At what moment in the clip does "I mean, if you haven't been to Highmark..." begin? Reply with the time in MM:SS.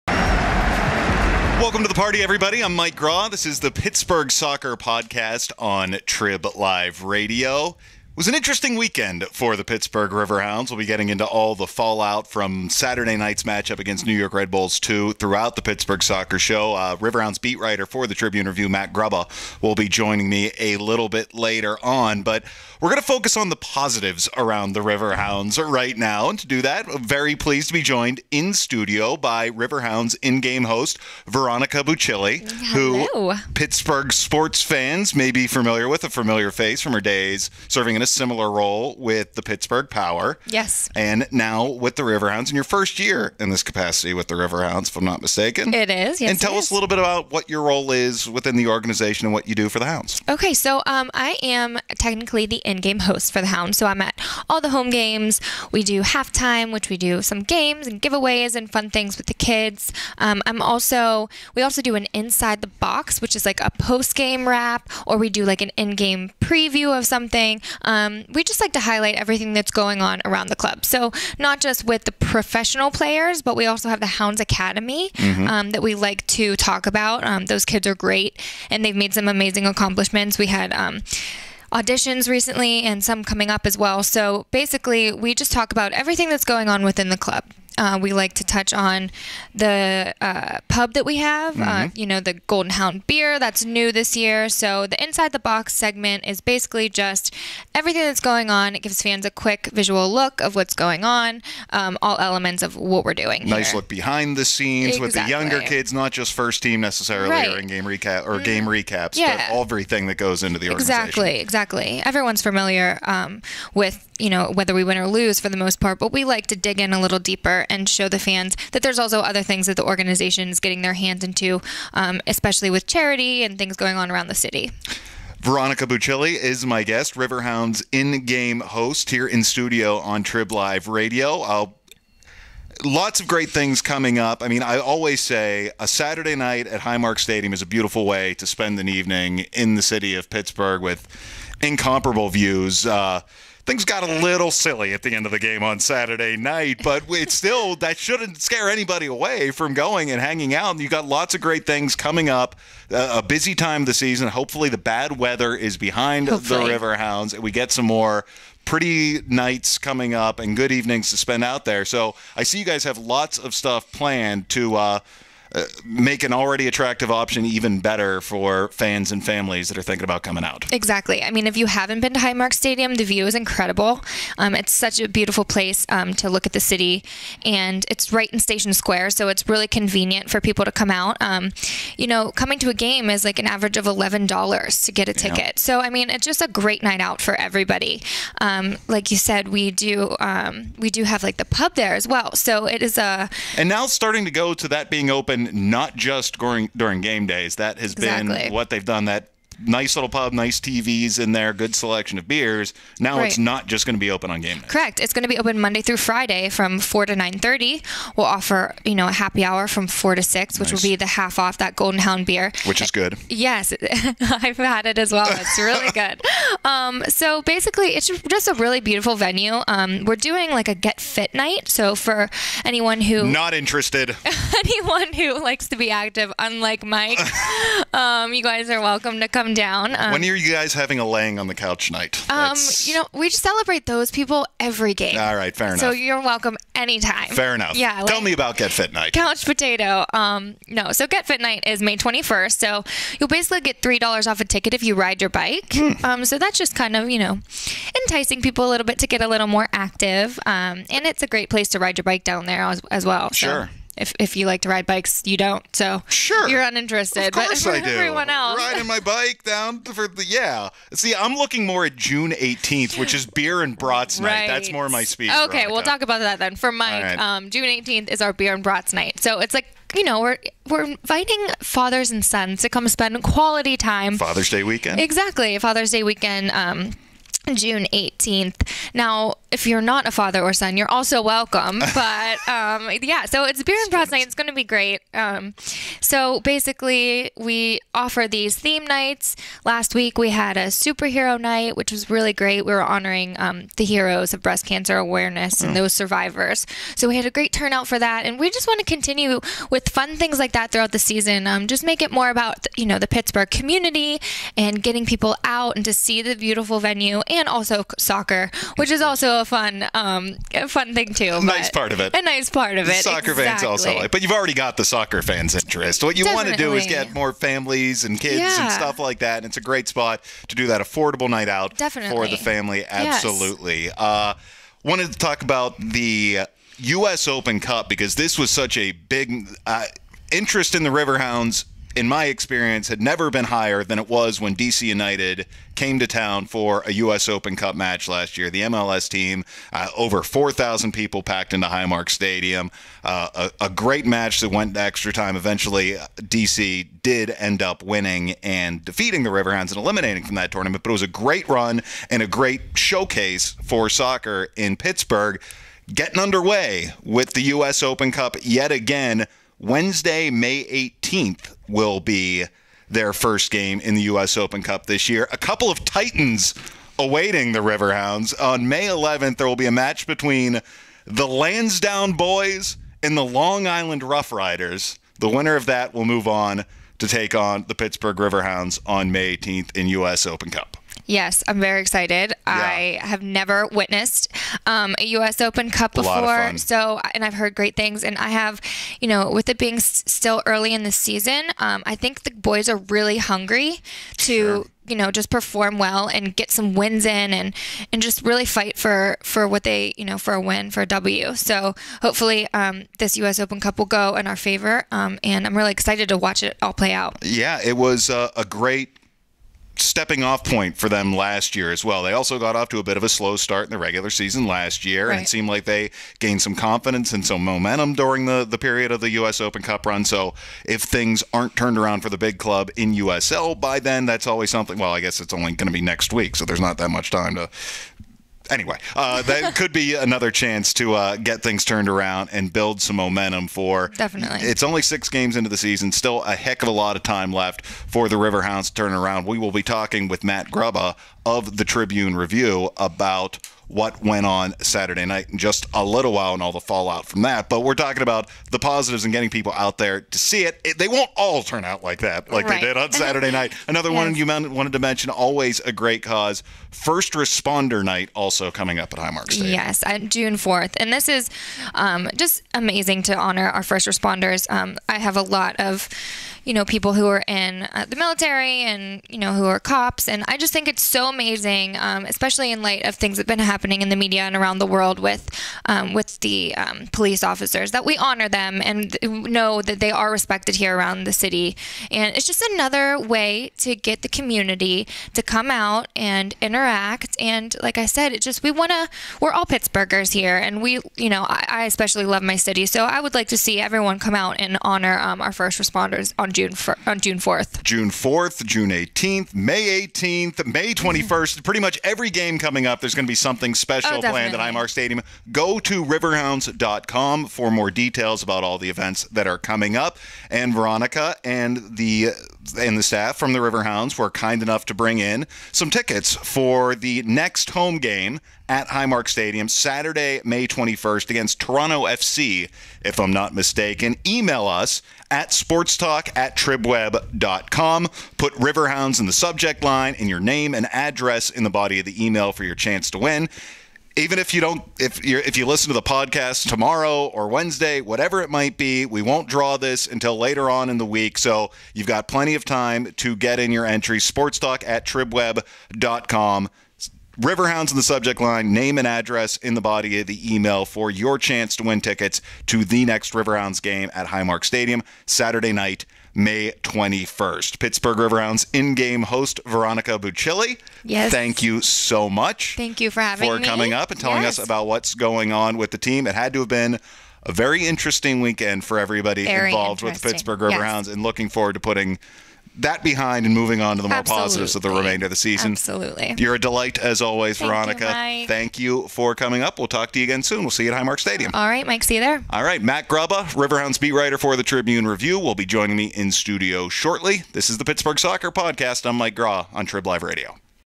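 02:51.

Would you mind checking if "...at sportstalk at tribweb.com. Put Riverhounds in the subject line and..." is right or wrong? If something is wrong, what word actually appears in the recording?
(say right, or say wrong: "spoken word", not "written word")
right.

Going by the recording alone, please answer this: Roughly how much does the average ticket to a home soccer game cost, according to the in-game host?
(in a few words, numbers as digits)
$11.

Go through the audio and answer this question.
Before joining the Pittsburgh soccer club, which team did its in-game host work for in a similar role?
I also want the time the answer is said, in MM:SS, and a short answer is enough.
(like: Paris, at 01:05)
Pittsburgh Power, at 00:39.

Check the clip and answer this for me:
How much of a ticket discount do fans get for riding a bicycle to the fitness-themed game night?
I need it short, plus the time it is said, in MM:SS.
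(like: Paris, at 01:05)
$3, at 04:03.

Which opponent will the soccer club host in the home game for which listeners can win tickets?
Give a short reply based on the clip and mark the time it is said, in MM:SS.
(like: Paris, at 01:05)
Toronto FC, at 08:41.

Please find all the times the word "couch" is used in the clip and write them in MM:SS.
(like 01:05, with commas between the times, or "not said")
03:51, 03:59.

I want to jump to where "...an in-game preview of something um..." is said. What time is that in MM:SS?
01:05.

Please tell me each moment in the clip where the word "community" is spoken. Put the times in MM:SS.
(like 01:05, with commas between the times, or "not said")
05:03, 08:04.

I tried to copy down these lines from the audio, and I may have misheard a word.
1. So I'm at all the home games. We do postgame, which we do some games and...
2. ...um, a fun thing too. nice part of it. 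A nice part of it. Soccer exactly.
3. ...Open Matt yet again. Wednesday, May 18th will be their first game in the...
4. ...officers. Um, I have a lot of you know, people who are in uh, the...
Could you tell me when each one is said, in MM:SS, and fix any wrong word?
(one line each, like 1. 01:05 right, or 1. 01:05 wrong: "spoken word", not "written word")
1. 00:53 wrong: "halftime", not "postgame"
2. 05:09 right
3. 05:57 wrong: "Cup", not "Matt"
4. 07:43 wrong: "responders", not "officers".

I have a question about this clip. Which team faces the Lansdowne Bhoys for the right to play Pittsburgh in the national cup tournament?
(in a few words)
Long Island Rough Riders.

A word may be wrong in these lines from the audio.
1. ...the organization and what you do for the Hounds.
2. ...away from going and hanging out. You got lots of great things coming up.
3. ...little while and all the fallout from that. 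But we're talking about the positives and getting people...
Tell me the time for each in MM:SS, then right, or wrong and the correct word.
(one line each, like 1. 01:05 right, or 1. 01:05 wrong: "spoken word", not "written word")
1. 00:48 right
2. 02:29 right
3. 07:25 right.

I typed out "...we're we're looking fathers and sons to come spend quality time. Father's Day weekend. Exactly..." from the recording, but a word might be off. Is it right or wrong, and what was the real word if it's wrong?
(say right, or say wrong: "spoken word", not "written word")
wrong: "inviting", not "looking".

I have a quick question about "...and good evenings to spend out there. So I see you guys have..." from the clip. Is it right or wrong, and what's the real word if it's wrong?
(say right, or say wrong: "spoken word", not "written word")
right.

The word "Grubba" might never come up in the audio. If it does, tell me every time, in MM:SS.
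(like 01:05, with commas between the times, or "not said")
00:18, 07:20, 09:42.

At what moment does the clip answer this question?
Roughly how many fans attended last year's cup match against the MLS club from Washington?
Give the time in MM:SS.
05:39.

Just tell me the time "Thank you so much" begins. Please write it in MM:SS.
09:21.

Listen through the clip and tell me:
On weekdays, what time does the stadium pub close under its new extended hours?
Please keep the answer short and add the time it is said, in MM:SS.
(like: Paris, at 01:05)
9:30, at 03:27.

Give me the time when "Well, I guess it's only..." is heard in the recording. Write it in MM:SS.
07:04.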